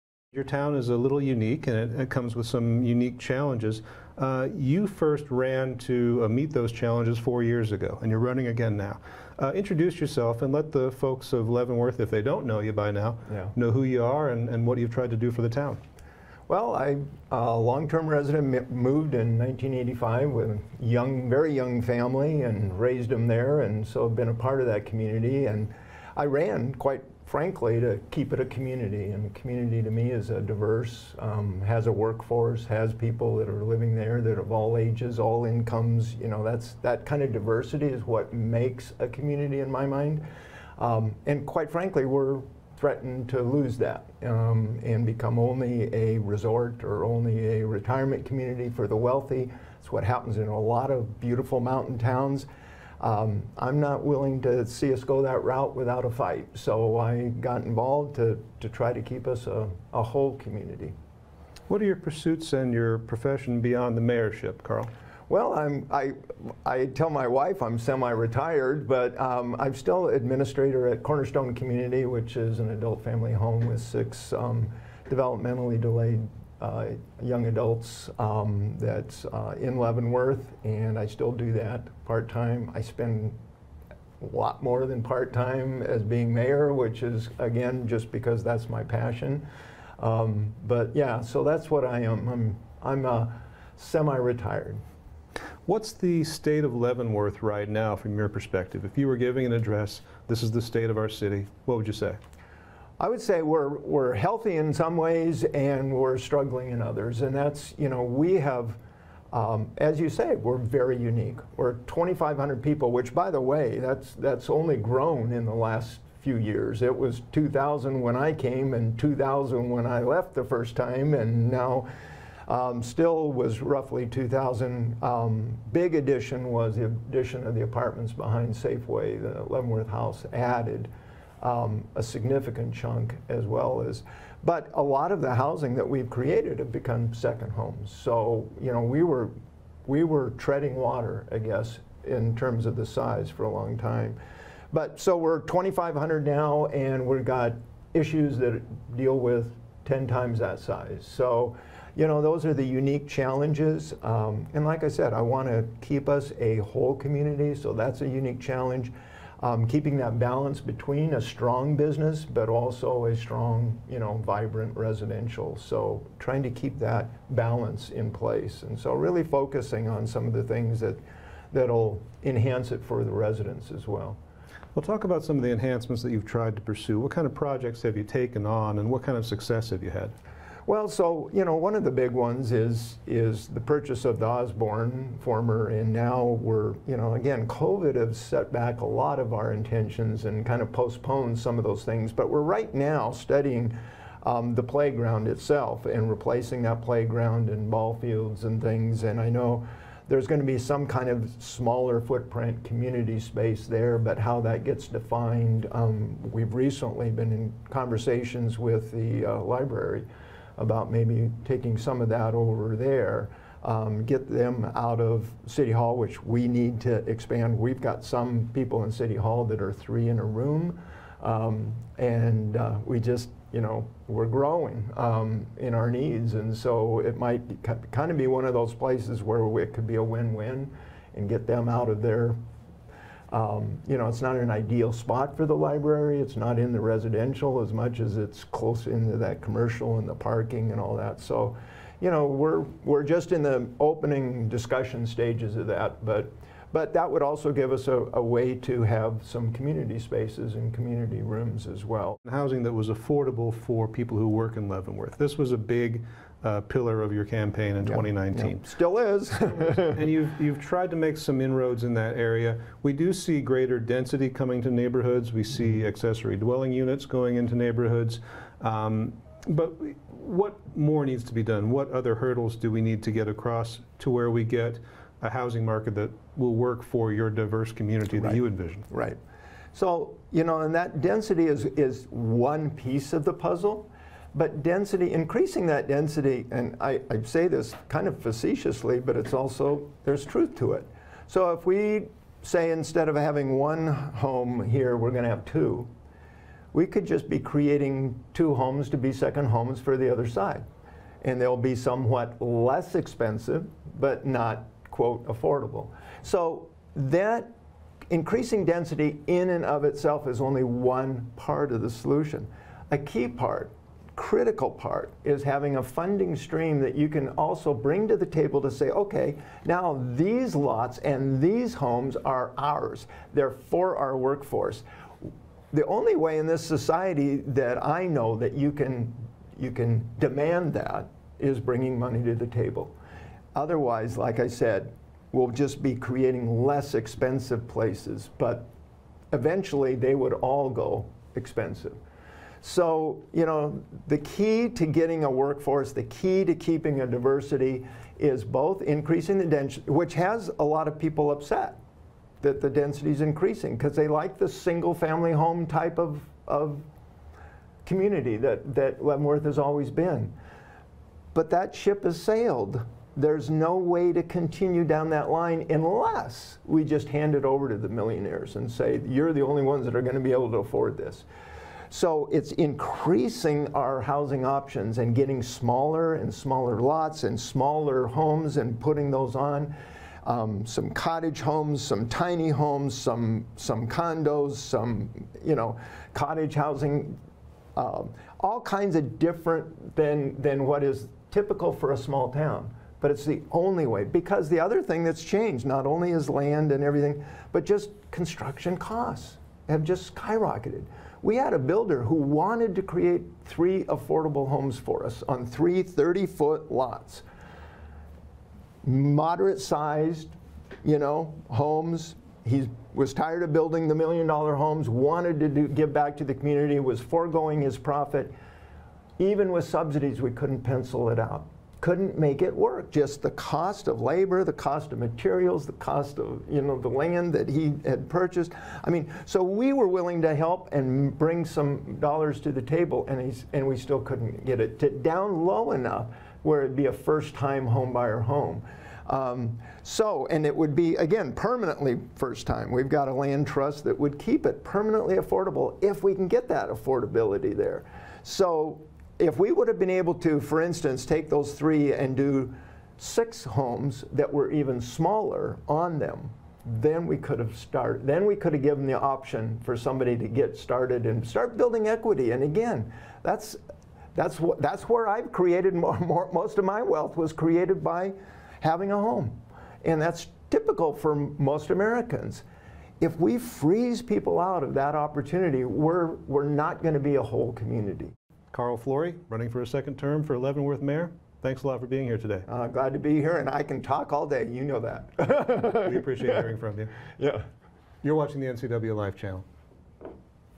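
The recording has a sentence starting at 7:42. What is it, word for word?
And again, that's, that's, what, that's where I've created more, more, most of my wealth was created by having a home.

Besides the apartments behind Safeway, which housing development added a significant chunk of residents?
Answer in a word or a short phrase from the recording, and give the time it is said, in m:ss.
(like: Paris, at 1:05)
Leavenworth House, at 2:09.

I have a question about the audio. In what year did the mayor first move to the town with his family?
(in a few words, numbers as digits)
1985.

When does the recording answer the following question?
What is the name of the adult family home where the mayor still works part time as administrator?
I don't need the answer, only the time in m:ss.
1:11.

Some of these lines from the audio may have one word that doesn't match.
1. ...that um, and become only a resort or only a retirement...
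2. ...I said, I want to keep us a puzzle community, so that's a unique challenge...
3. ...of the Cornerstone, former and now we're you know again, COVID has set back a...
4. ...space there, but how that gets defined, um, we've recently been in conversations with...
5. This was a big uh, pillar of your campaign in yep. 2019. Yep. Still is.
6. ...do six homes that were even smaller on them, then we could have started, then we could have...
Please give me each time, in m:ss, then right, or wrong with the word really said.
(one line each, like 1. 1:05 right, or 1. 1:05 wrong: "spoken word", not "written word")
1. 0:43 right
2. 2:34 wrong: "whole", not "puzzle"
3. 3:04 wrong: "Osborn", not "Cornerstone"
4. 3:23 right
5. 4:15 right
6. 7:32 right.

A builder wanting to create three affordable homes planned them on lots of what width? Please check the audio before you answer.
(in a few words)
30 feet.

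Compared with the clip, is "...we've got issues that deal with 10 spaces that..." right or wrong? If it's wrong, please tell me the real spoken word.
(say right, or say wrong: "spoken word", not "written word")
wrong: "times", not "spaces".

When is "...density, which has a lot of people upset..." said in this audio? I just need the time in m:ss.
5:49.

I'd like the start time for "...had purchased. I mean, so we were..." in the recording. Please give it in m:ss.
7:07.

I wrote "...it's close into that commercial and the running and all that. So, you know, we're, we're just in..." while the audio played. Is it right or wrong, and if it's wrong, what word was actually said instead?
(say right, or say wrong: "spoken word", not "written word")
wrong: "parking", not "running".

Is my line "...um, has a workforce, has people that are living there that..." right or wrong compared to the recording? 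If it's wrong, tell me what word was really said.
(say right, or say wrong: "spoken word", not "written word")
right.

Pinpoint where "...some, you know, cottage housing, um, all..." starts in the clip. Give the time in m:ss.
6:24.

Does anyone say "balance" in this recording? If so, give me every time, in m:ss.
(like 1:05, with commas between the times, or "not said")
2:40, 2:47.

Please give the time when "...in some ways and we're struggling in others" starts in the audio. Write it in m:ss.
1:44.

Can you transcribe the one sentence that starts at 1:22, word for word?
I spend a lot more than part time as being mayor, which is again just because that's my passion.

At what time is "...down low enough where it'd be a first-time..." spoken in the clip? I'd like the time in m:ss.
7:14.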